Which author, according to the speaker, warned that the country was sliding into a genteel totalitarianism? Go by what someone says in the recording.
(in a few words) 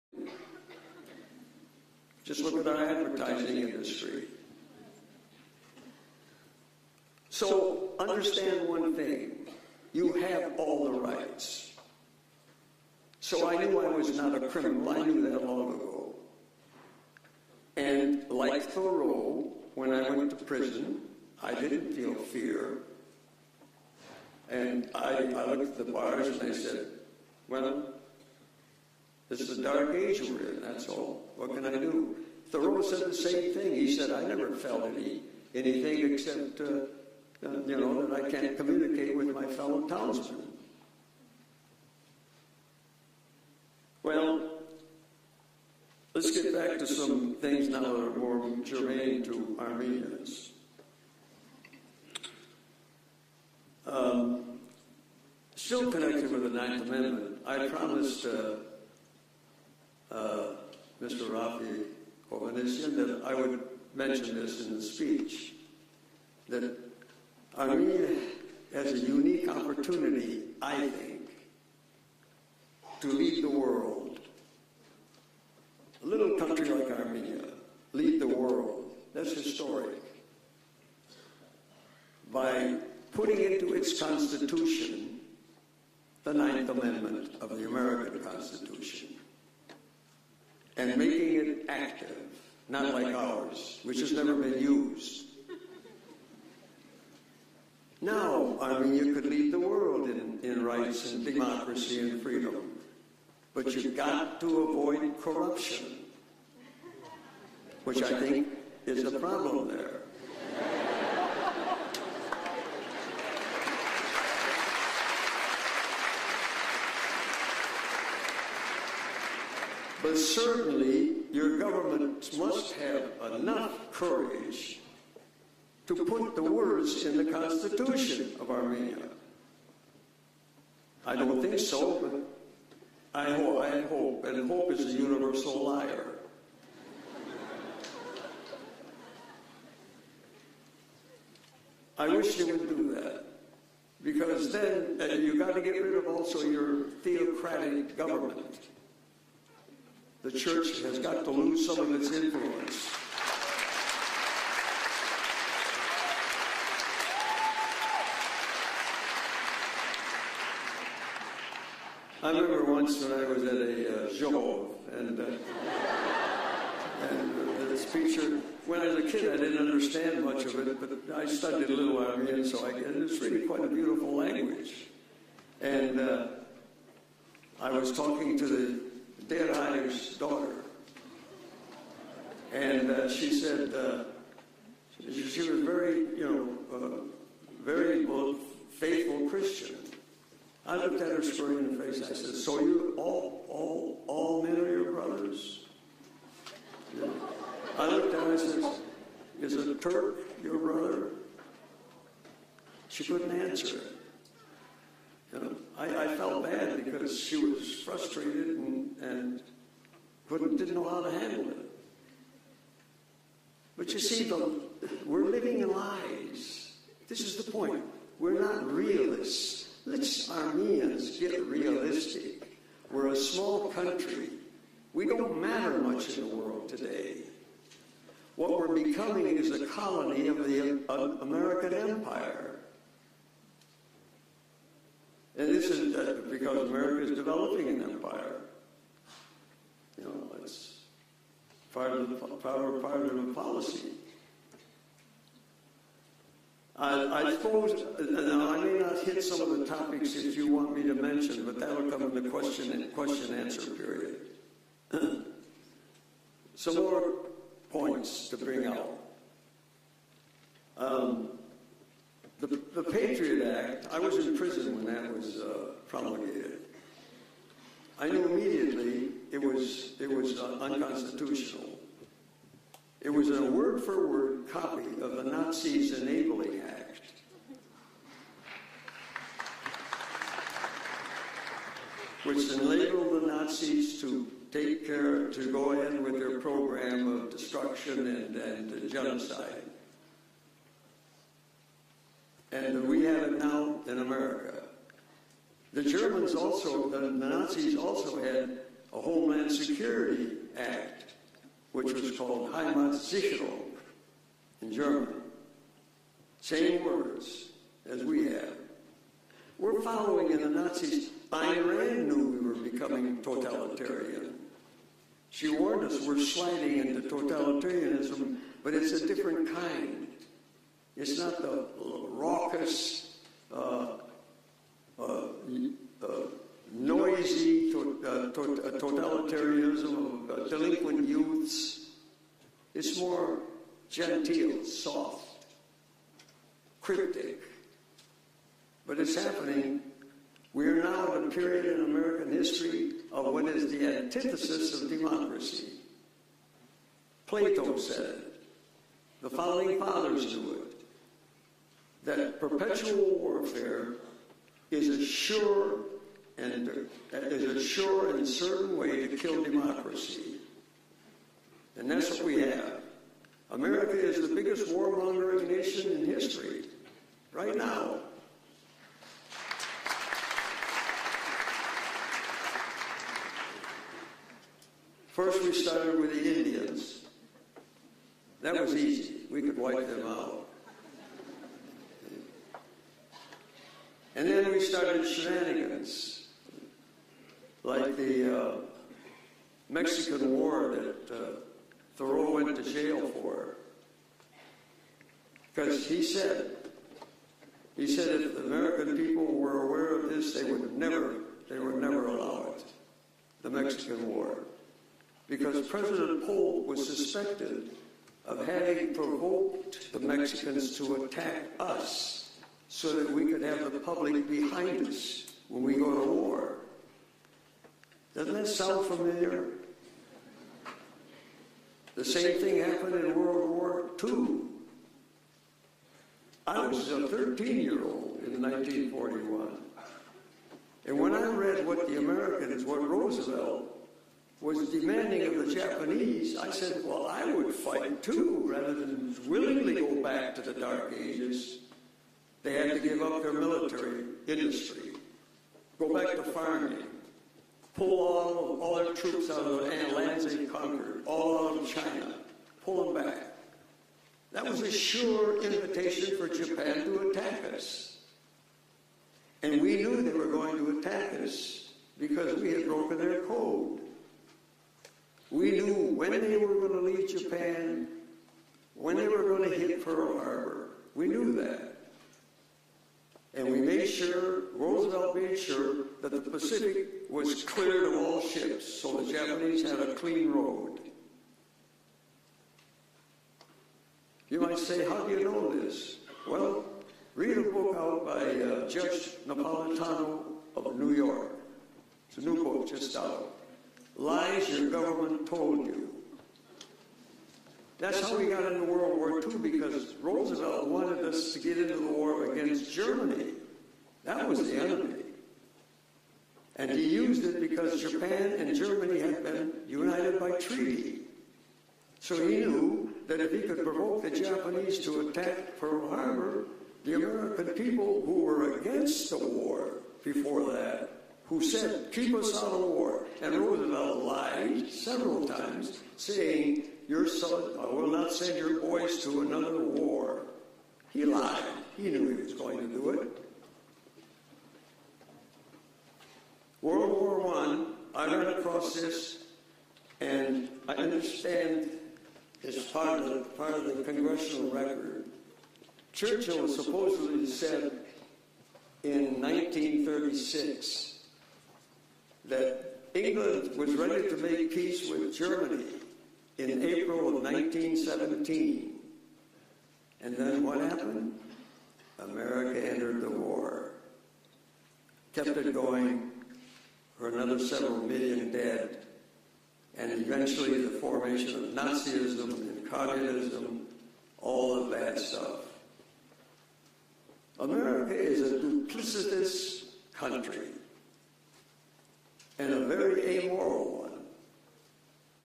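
Ayn Rand.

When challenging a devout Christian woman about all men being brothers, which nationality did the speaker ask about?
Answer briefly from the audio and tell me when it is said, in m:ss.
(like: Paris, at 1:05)
Turk, at 3:19.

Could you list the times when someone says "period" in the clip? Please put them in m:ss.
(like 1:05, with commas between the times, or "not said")
4:13, 5:41.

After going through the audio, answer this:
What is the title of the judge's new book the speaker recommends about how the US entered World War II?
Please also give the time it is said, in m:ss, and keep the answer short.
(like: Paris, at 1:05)
Lies Your Government Told You, at 8:13.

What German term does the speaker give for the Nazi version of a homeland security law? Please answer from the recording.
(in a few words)
Heimatsicherung.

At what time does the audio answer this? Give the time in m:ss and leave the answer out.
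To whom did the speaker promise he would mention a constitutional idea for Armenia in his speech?
1:01.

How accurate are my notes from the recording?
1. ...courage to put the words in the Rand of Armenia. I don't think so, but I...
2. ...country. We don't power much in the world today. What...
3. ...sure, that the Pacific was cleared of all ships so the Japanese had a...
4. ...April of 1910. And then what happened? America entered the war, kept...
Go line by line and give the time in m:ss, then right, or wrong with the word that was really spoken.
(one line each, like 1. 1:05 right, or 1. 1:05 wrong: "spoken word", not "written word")
1. 2:03 wrong: "Constitution", not "Rand"
2. 3:43 wrong: "matter", not "power"
3. 7:55 right
4. 9:16 wrong: "1917", not "1910".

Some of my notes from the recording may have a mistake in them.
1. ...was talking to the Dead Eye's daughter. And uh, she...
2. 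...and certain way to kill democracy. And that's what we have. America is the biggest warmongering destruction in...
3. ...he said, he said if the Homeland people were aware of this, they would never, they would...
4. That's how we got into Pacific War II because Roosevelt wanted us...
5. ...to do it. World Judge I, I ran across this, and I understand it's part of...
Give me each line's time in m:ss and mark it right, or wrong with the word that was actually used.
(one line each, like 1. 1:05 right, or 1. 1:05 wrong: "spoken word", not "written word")
1. 2:57 right
2. 5:58 wrong: "nation", not "destruction"
3. 6:35 wrong: "American", not "Homeland"
4. 8:17 wrong: "World", not "Pacific"
5. 8:52 wrong: "War", not "Judge".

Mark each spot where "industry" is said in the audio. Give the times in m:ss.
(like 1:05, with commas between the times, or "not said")
0:03, 7:24.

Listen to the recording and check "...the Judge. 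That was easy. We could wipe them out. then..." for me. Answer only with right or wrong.
wrong.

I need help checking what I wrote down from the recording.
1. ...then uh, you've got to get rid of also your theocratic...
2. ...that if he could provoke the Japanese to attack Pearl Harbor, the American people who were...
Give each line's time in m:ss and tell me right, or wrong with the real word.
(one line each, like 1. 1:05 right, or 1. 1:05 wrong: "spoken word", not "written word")
1. 2:24 right
2. 8:33 right.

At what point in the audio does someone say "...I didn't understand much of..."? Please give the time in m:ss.
2:49.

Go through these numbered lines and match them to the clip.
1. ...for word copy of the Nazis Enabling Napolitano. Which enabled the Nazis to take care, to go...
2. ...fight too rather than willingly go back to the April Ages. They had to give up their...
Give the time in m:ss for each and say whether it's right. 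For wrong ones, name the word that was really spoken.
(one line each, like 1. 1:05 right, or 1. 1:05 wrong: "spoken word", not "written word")
1. 4:33 wrong: "Act", not "Napolitano"
2. 7:17 wrong: "Dark", not "April".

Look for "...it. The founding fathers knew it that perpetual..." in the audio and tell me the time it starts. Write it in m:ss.
5:48.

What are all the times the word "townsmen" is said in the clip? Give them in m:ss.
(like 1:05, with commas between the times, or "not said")
0:39.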